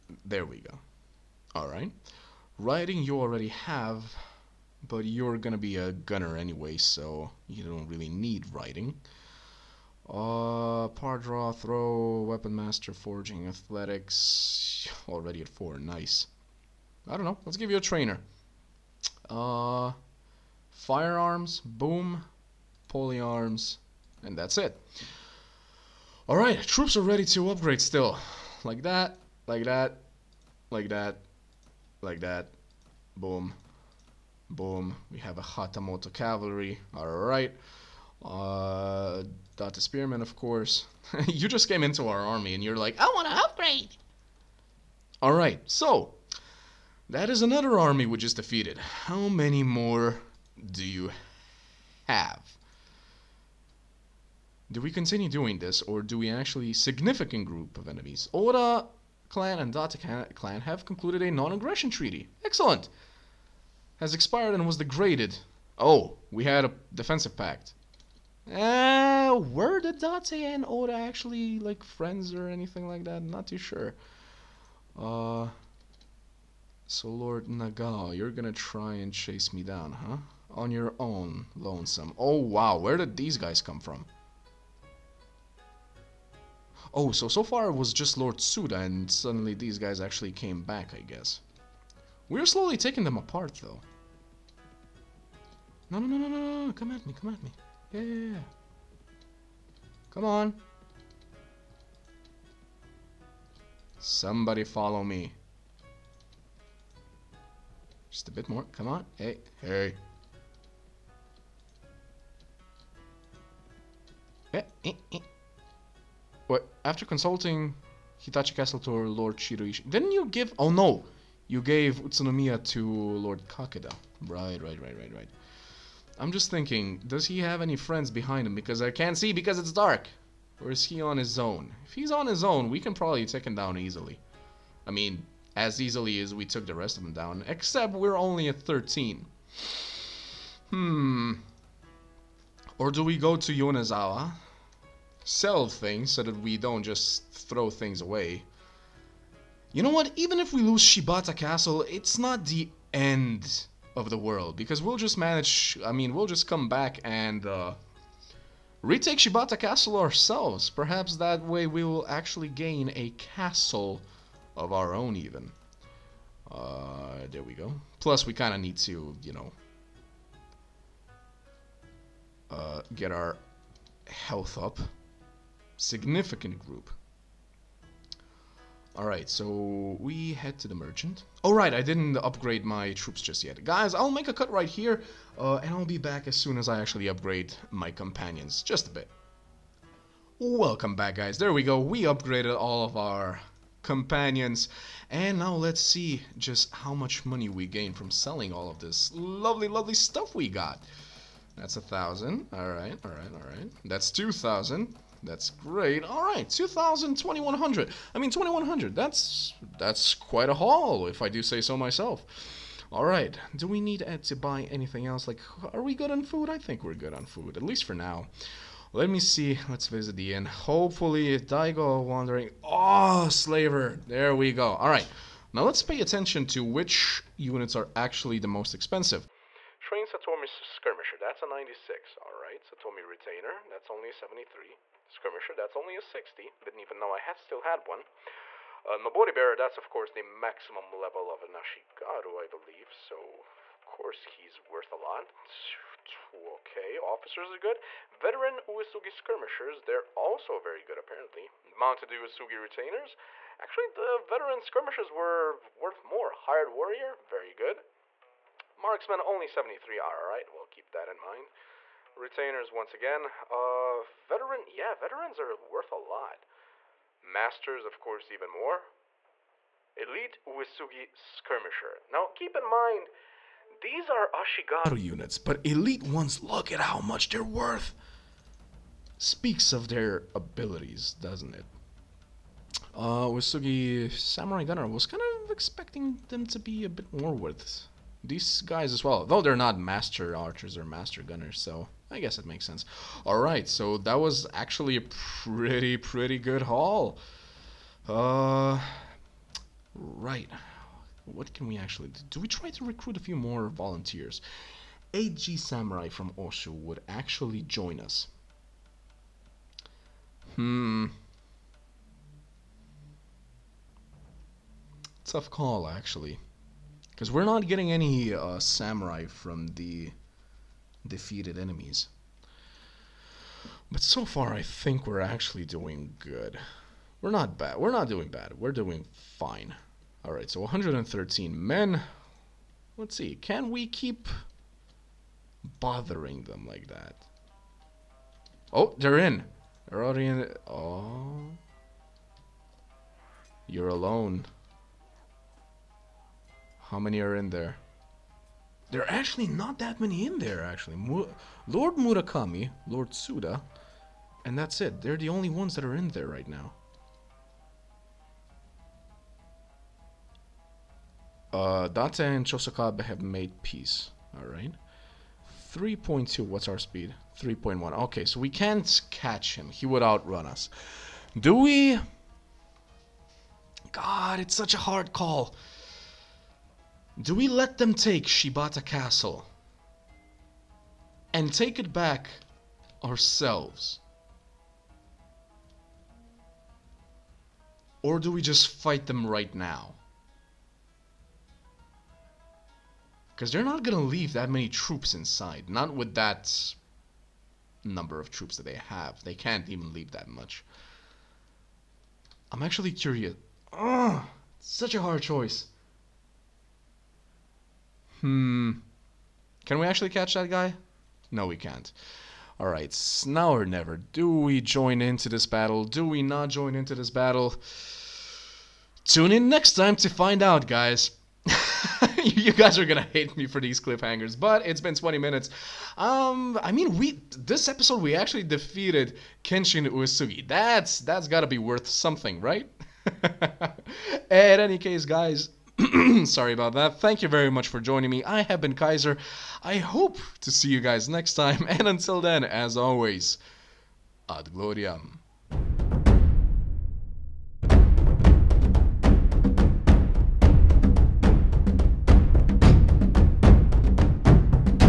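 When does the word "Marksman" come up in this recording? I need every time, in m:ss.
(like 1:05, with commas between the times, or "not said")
4:18.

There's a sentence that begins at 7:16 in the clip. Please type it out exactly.
Thank you very much for joining me.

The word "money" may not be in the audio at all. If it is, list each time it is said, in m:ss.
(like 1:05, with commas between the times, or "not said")
3:17.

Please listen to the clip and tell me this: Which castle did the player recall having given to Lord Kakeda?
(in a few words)
Utsunomiya.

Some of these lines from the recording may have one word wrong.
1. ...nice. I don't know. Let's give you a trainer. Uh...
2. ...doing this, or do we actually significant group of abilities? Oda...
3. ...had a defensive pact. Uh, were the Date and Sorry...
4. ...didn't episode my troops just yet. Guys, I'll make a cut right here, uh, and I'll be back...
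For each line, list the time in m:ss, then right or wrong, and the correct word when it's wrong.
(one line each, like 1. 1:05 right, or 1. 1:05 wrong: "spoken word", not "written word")
1. 0:15 right
2. 0:55 wrong: "enemies", not "abilities"
3. 1:06 wrong: "Oda", not "Sorry"
4. 3:01 wrong: "upgrade", not "episode".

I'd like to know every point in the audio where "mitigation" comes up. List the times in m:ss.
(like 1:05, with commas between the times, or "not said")
not said.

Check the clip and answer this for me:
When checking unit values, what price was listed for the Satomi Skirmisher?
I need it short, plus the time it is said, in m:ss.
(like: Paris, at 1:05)
96, at 3:51.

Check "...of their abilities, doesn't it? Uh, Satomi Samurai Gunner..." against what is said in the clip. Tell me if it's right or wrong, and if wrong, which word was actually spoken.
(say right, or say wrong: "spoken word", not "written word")
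wrong: "Uesugi", not "Satomi".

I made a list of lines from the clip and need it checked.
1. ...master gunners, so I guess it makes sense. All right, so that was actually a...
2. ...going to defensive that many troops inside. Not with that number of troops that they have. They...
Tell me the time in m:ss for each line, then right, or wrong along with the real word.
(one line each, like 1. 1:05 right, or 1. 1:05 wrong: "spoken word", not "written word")
1. 4:50 right
2. 6:33 wrong: "leave", not "defensive".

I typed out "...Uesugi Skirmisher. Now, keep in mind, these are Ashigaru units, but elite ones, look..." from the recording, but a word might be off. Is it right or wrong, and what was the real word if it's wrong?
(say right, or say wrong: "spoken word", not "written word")
right.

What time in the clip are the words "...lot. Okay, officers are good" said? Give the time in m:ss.
4:04.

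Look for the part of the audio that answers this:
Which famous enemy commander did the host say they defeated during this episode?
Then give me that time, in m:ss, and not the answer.
7:09.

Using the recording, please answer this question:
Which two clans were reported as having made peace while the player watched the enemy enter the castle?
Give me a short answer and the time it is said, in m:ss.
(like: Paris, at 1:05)
Date and Chosokabe, at 6:01.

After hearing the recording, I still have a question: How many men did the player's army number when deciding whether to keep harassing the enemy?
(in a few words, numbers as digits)
113.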